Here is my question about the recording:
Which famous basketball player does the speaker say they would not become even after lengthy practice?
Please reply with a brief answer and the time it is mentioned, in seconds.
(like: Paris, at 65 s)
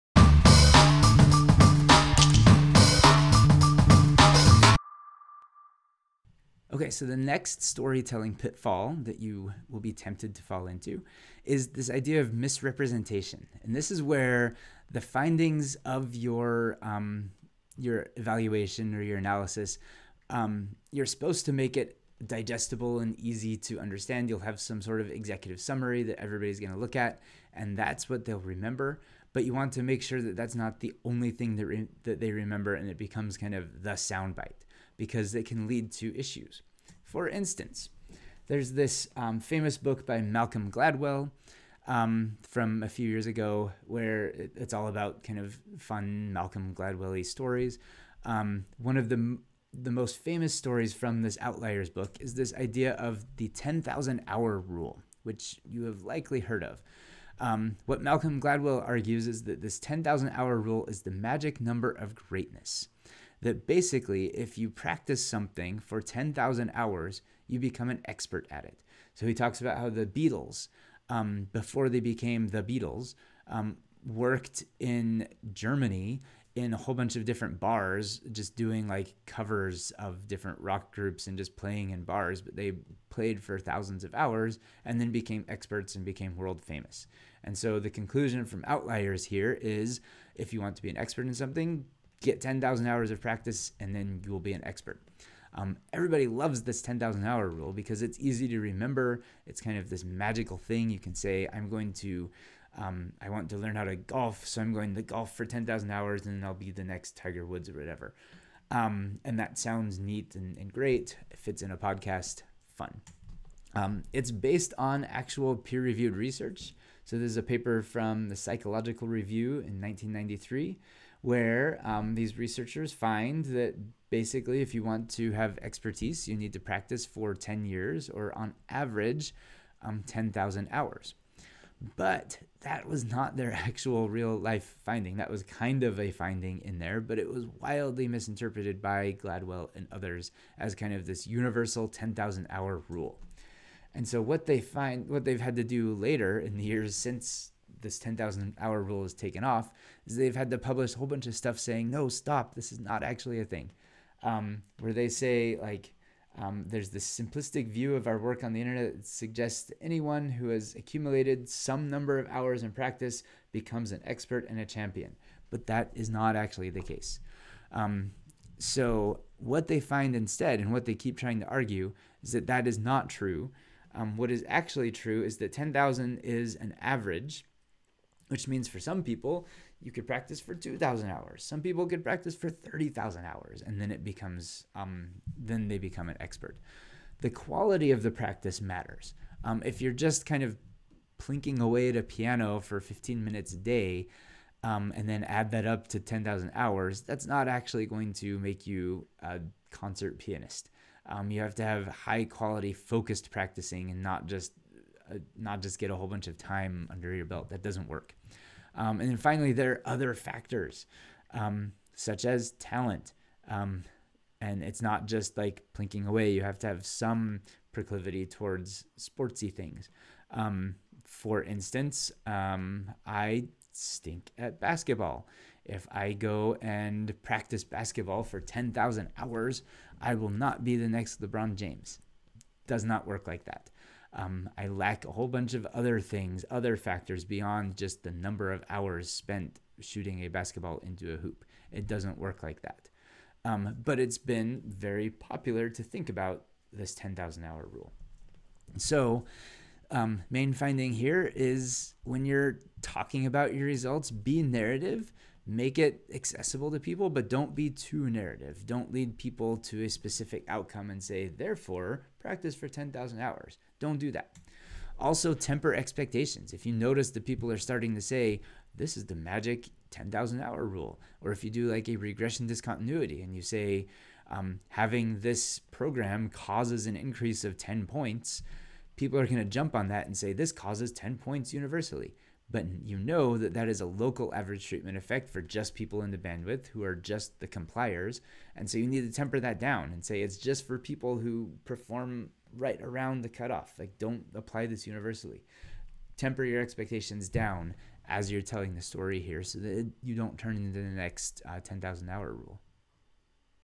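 LeBron James, at 231 s.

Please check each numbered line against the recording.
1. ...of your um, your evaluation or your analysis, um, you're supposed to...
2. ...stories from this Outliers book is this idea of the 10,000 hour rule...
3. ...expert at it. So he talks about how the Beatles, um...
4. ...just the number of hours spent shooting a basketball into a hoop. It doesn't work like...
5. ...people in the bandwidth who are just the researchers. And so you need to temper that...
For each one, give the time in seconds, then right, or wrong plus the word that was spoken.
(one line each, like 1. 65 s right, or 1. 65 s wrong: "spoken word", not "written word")
1. 15 s right
2. 50 s right
3. 68 s right
4. 237 s right
5. 285 s wrong: "compliers", not "researchers".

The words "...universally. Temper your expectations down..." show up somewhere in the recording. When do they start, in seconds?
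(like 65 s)
294 s.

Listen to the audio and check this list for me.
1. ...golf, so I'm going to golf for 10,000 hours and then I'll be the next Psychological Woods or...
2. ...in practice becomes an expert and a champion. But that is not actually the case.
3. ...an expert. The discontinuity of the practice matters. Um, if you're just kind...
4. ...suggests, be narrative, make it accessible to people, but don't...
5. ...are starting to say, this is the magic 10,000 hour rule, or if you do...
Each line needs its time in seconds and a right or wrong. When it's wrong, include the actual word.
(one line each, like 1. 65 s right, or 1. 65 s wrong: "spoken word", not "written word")
1. 103 s wrong: "Tiger", not "Psychological"
2. 162 s right
3. 186 s wrong: "quality", not "discontinuity"
4. 253 s wrong: "results", not "suggests"
5. 267 s right.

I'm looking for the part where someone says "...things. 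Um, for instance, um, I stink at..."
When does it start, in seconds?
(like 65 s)
219 s.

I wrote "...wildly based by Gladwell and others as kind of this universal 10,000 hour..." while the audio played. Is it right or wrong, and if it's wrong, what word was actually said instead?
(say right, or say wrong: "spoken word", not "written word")
wrong: "misinterpreted", not "based".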